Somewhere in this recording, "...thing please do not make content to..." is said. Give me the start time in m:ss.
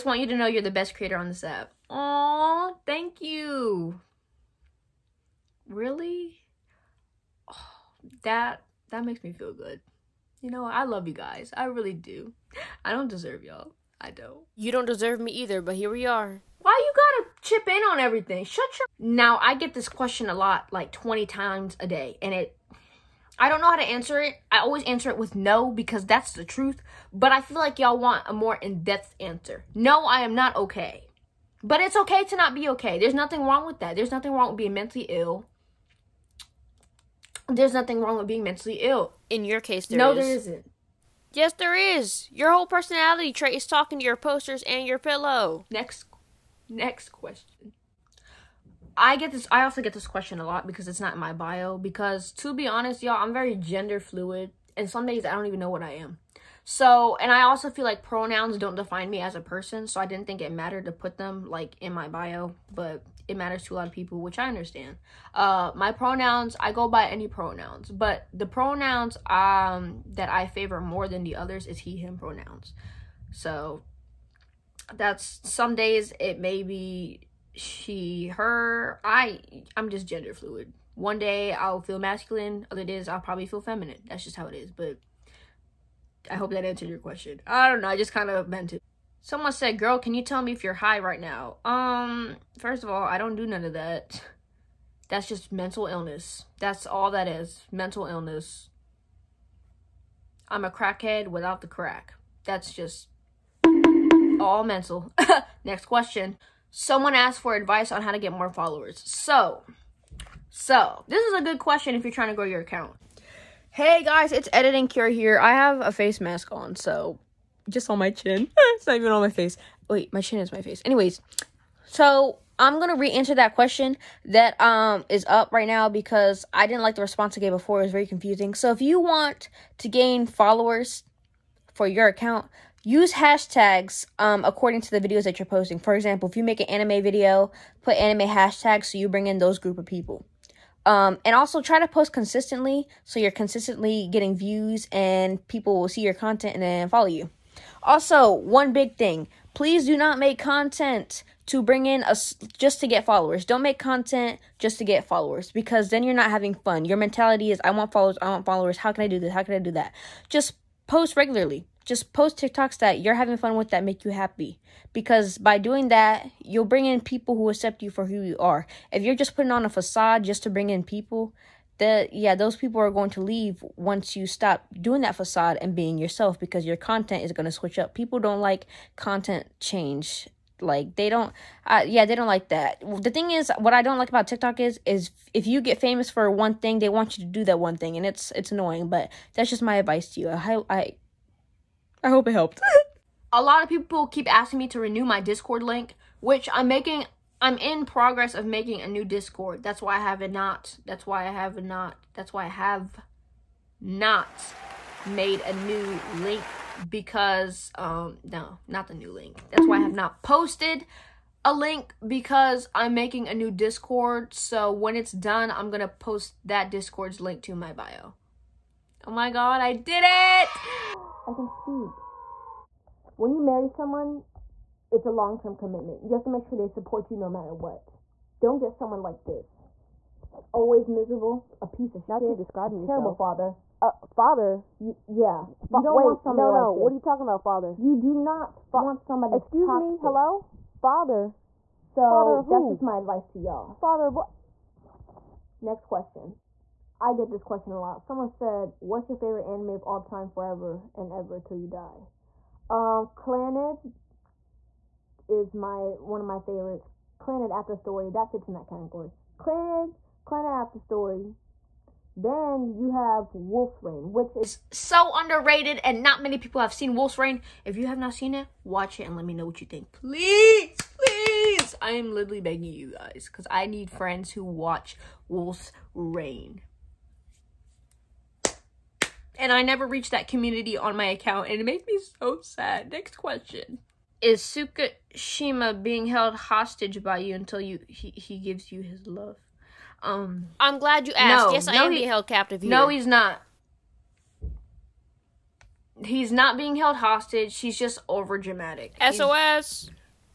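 2:28.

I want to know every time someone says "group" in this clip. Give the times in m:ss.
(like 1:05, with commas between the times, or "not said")
2:19.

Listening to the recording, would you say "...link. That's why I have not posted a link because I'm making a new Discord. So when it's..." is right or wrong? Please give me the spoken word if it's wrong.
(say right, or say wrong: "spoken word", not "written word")
right.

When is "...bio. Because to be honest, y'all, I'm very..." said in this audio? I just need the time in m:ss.
0:51.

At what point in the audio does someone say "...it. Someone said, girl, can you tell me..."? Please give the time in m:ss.
1:28.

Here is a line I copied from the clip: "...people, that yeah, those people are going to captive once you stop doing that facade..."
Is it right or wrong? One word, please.
wrong.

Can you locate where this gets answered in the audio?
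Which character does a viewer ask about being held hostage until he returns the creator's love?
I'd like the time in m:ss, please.
4:44.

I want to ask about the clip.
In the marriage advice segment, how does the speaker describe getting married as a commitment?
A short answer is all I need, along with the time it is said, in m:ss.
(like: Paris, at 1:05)
long-term commitment, at 3:45.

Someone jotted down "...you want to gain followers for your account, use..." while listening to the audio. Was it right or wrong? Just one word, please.
right.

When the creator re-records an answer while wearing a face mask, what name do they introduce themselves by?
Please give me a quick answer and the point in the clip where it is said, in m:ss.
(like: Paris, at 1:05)
Editing Cure, at 1:54.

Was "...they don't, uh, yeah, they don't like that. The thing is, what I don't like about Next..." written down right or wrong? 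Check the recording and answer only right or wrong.
wrong.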